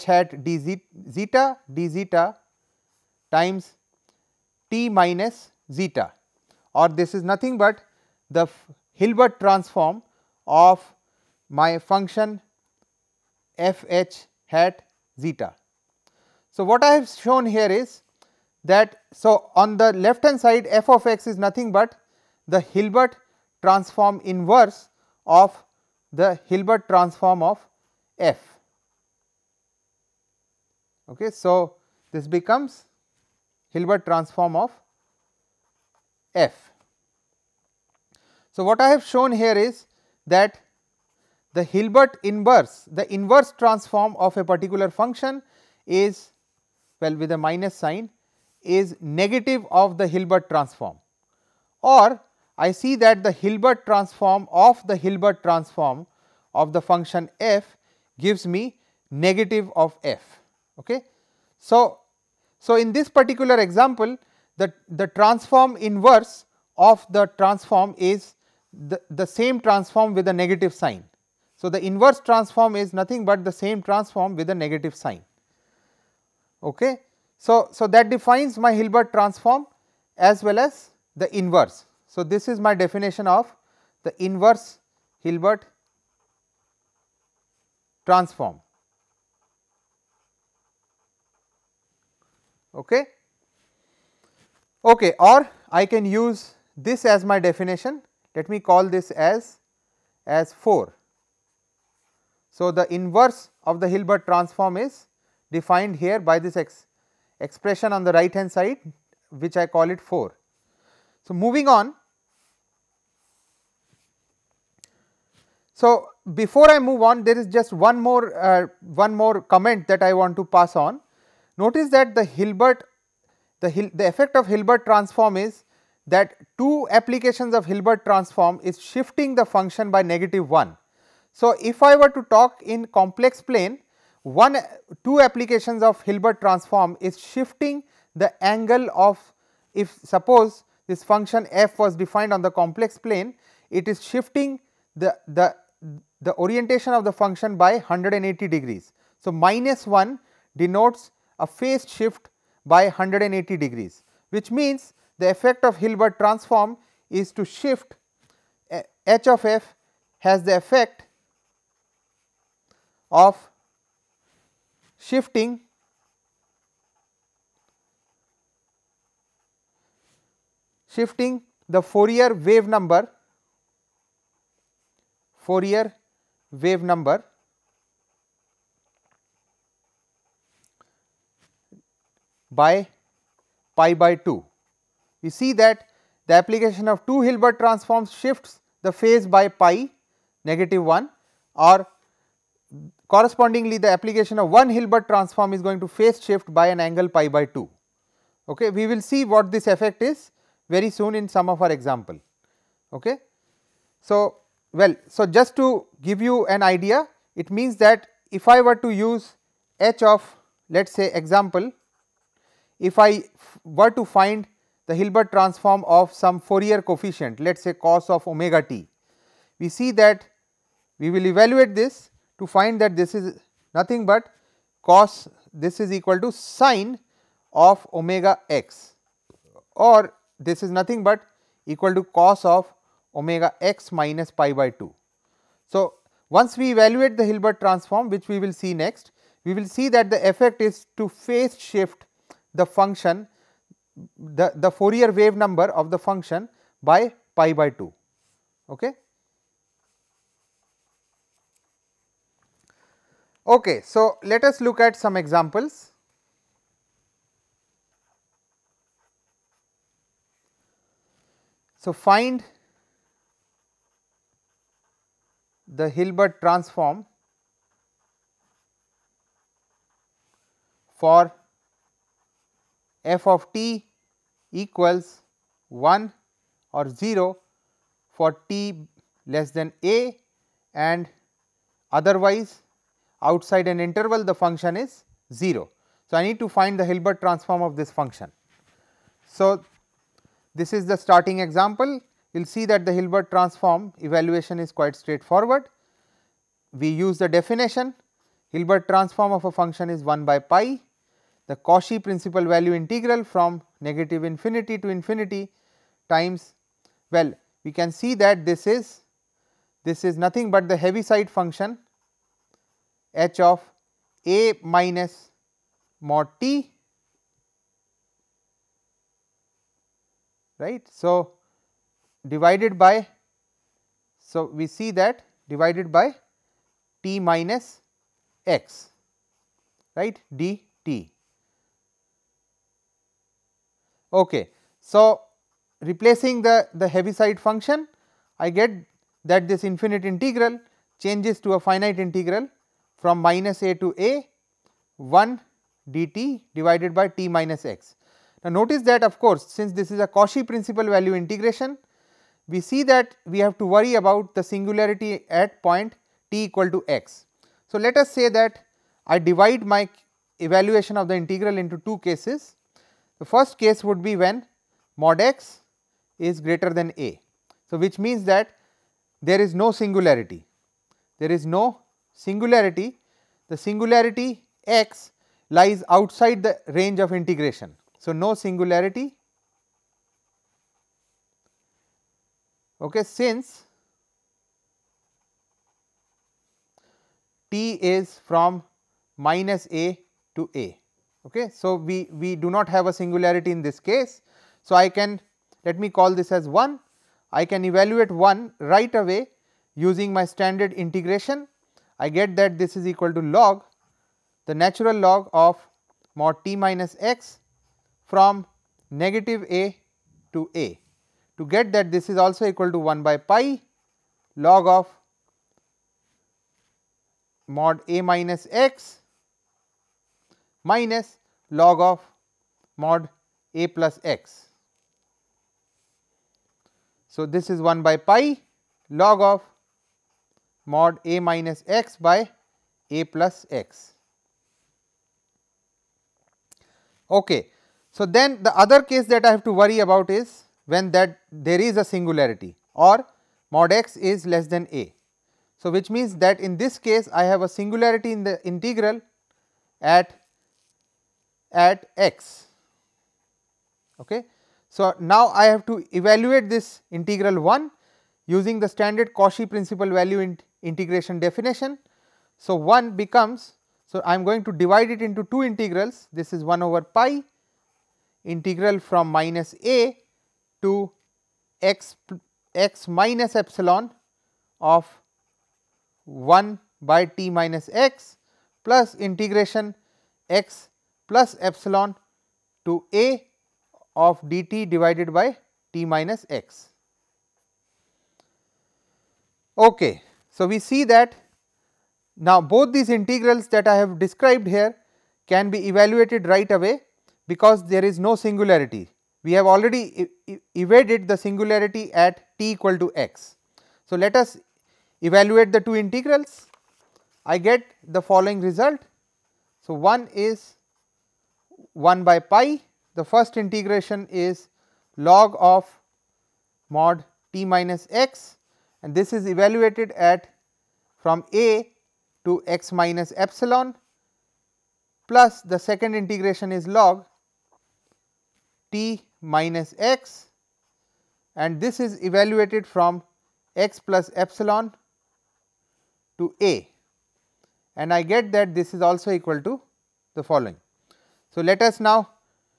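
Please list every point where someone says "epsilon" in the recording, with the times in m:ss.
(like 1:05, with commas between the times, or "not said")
7:53, 8:01, 8:43, 8:54.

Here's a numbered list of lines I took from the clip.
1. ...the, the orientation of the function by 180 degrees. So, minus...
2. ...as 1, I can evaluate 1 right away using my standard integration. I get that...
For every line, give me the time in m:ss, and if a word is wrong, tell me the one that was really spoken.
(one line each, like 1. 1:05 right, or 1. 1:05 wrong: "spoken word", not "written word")
1. 2:25 right
2. 6:36 right.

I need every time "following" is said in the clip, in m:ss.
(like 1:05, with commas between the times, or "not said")
8:28, 9:00.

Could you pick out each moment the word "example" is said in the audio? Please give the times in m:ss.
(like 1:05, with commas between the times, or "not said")
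1:03, 3:21, 3:31, 4:15, 4:51.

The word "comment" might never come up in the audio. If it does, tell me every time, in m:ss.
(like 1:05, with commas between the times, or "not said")
1:59.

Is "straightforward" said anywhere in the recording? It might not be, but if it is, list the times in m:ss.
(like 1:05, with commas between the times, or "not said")
4:54.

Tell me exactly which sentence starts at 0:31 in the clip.
Okay, so, this becomes Hilbert transform of f.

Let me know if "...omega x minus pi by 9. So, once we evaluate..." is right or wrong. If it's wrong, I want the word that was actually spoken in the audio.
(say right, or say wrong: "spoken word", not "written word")
wrong: "2", not "9".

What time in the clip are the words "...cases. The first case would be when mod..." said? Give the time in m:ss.
6:01.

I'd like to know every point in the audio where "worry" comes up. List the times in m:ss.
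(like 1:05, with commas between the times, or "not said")
5:53, 7:19.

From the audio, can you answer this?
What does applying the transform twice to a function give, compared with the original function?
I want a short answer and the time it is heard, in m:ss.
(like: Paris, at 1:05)
negative of f, at 0:59.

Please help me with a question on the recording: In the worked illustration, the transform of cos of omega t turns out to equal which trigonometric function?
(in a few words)
sine of omega x.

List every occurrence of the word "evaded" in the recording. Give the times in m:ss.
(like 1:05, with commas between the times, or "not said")
8:20.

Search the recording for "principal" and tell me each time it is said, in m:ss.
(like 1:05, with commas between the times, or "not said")
5:02, 5:50, 7:39.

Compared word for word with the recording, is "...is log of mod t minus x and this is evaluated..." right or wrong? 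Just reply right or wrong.
right.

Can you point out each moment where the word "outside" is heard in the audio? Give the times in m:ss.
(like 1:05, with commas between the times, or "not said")
4:43, 6:15.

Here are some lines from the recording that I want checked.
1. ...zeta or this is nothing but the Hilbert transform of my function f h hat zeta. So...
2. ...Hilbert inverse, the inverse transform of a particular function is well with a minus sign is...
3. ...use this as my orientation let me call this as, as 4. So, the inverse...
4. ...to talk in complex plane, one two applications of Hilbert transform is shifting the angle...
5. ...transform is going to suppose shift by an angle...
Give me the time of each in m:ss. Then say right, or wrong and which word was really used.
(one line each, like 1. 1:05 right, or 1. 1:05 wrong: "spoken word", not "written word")
1. 0:05 right
2. 0:41 right
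3. 1:36 wrong: "definition", not "orientation"
4. 2:12 right
5. 3:15 wrong: "phase", not "suppose".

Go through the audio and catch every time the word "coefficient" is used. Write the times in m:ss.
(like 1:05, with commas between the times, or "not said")
3:36.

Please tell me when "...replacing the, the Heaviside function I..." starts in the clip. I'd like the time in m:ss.
5:35.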